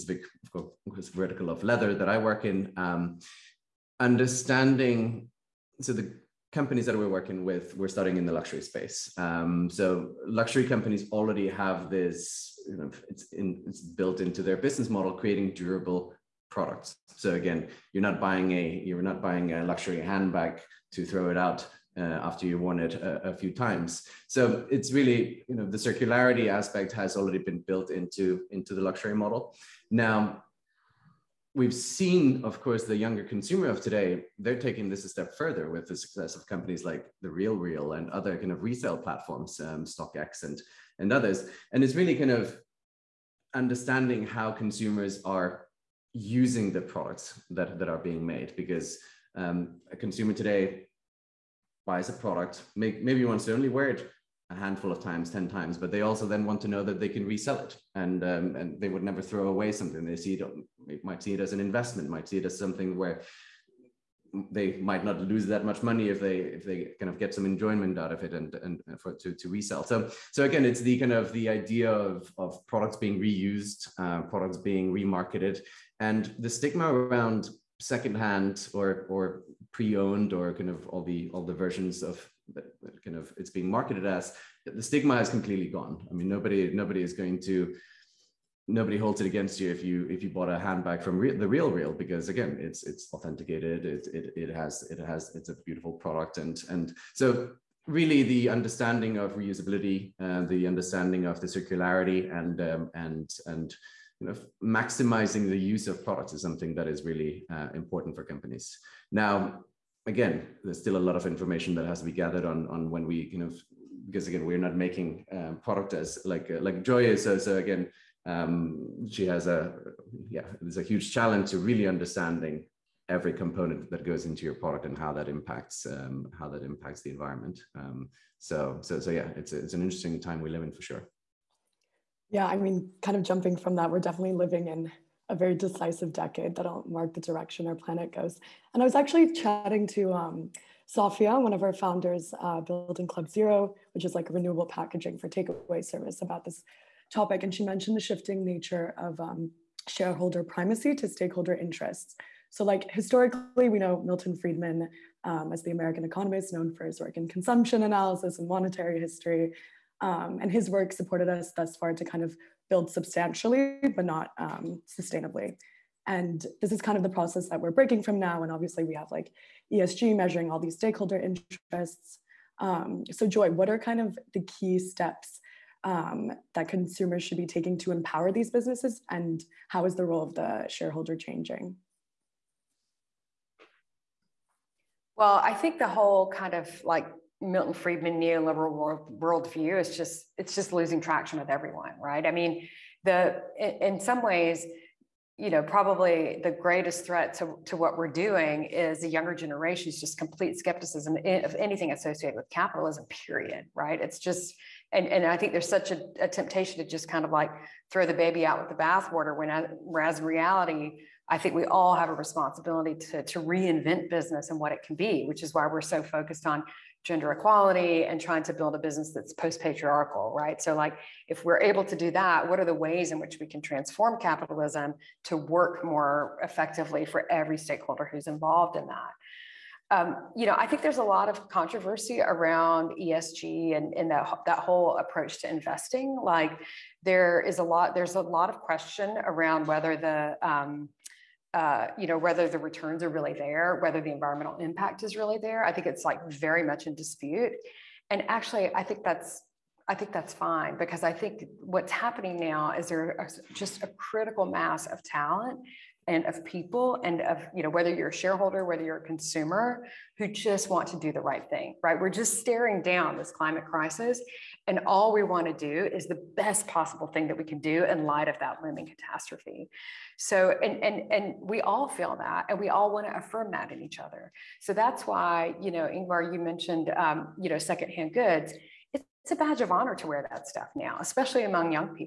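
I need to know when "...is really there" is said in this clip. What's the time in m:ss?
4:05.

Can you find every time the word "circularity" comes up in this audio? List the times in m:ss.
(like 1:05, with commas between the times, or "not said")
0:25, 1:41.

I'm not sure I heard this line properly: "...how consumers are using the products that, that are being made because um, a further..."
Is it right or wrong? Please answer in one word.
wrong.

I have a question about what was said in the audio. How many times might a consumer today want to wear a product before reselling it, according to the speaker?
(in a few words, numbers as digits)
10.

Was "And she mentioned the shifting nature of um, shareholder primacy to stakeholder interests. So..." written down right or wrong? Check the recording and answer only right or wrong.
right.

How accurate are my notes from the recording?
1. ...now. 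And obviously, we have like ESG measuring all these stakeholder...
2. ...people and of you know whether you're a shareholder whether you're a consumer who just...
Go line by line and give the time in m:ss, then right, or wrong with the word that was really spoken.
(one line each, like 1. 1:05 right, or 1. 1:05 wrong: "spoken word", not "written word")
1. 2:48 right
2. 4:16 right.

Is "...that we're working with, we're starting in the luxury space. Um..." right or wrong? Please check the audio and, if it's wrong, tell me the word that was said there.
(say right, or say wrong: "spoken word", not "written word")
right.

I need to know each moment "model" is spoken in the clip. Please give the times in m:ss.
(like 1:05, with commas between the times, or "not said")
0:14, 0:29.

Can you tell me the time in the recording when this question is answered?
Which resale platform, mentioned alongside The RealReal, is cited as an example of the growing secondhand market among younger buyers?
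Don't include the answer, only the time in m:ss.
0:39.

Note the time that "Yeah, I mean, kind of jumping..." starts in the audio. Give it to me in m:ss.
2:12.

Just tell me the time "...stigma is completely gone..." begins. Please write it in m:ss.
1:24.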